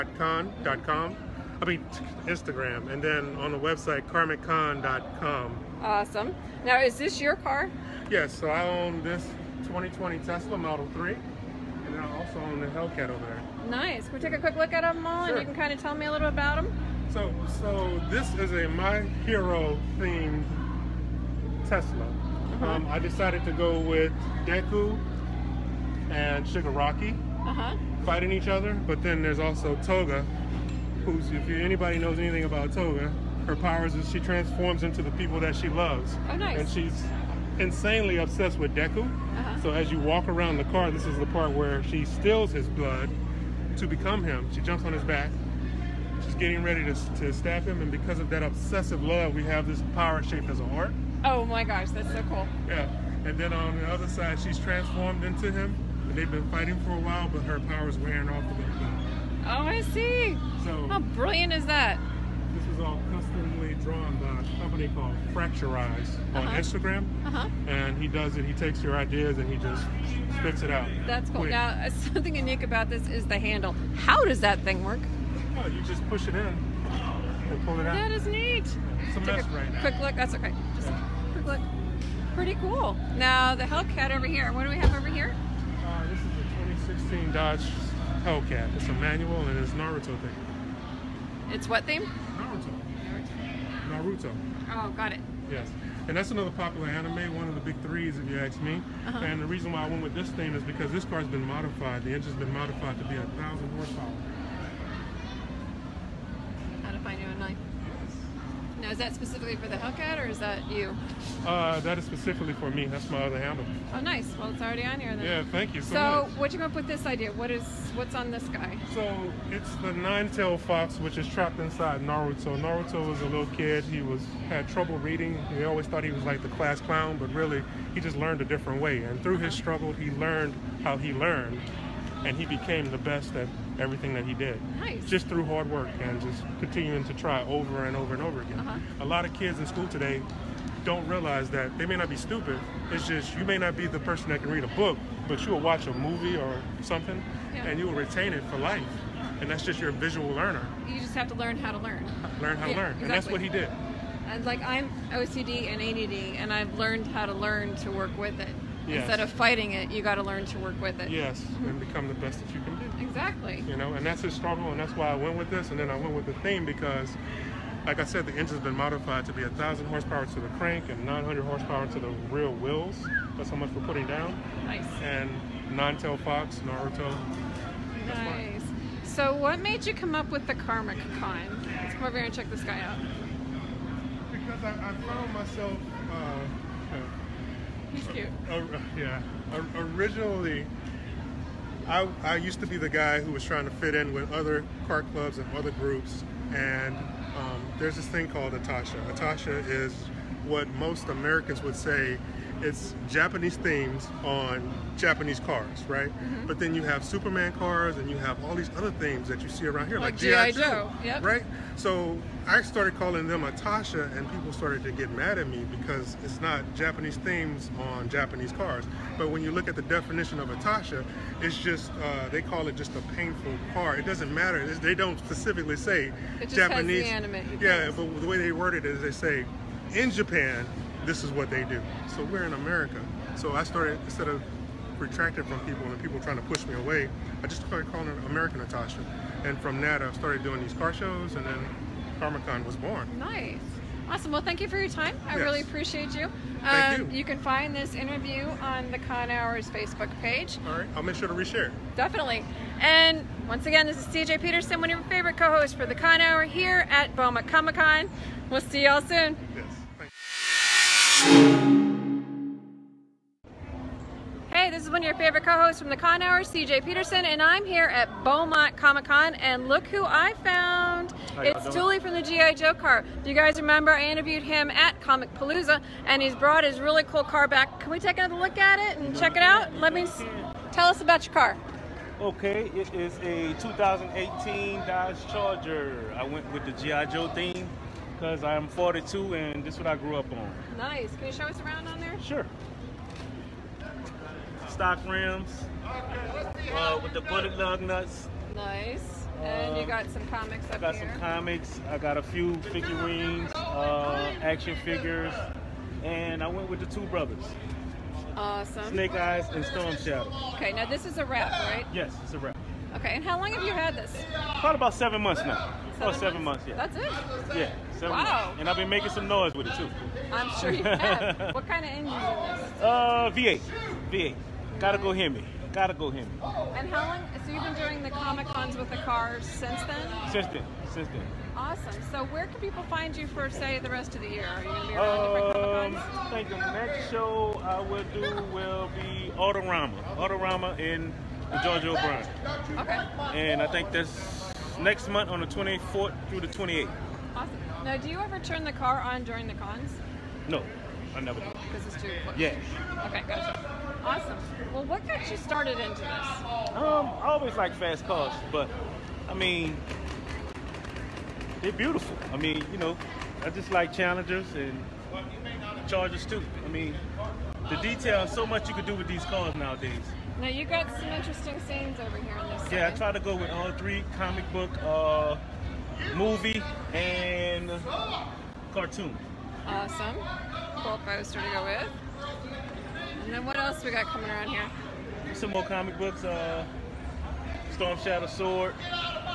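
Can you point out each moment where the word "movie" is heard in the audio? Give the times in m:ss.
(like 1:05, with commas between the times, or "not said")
2:25, 6:16.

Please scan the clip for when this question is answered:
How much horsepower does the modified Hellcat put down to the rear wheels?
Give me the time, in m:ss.
2:51.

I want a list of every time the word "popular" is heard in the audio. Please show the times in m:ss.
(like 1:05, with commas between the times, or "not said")
1:36.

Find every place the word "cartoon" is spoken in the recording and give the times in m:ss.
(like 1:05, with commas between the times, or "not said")
6:18.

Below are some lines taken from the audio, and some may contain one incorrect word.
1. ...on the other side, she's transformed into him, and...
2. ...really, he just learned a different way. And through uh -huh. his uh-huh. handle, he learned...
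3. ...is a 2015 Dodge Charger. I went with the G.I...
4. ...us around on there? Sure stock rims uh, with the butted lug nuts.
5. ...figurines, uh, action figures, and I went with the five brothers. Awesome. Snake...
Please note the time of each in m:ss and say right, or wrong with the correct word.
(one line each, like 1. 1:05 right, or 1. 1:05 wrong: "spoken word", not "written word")
1. 0:53 right
2. 2:07 wrong: "struggle", not "handle"
3. 4:42 wrong: "2018", not "2015"
4. 4:51 right
5. 5:02 wrong: "two", not "five".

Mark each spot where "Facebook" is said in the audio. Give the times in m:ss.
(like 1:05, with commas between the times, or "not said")
4:09.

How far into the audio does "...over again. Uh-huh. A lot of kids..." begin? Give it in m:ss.
2:18.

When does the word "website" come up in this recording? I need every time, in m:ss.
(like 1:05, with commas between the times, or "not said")
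0:03.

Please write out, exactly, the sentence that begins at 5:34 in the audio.
Are you gonna be around um, I think the next show I will do will be Autorama.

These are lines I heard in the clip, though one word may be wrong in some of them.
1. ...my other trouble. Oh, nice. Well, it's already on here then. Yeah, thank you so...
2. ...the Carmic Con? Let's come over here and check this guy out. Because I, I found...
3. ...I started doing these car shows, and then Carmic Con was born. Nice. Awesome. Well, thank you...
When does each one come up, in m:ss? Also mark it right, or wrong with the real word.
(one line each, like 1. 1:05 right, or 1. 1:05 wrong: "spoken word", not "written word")
1. 1:53 wrong: "handle", not "trouble"
2. 3:00 right
3. 4:00 right.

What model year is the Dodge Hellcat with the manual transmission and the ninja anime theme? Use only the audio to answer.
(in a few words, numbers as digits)
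2016.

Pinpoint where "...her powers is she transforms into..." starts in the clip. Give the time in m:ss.
0:33.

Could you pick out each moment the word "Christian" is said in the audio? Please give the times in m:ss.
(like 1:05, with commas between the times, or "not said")
not said.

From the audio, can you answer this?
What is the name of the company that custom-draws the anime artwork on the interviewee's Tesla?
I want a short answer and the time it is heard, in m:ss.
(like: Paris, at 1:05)
Fracturize, at 1:05.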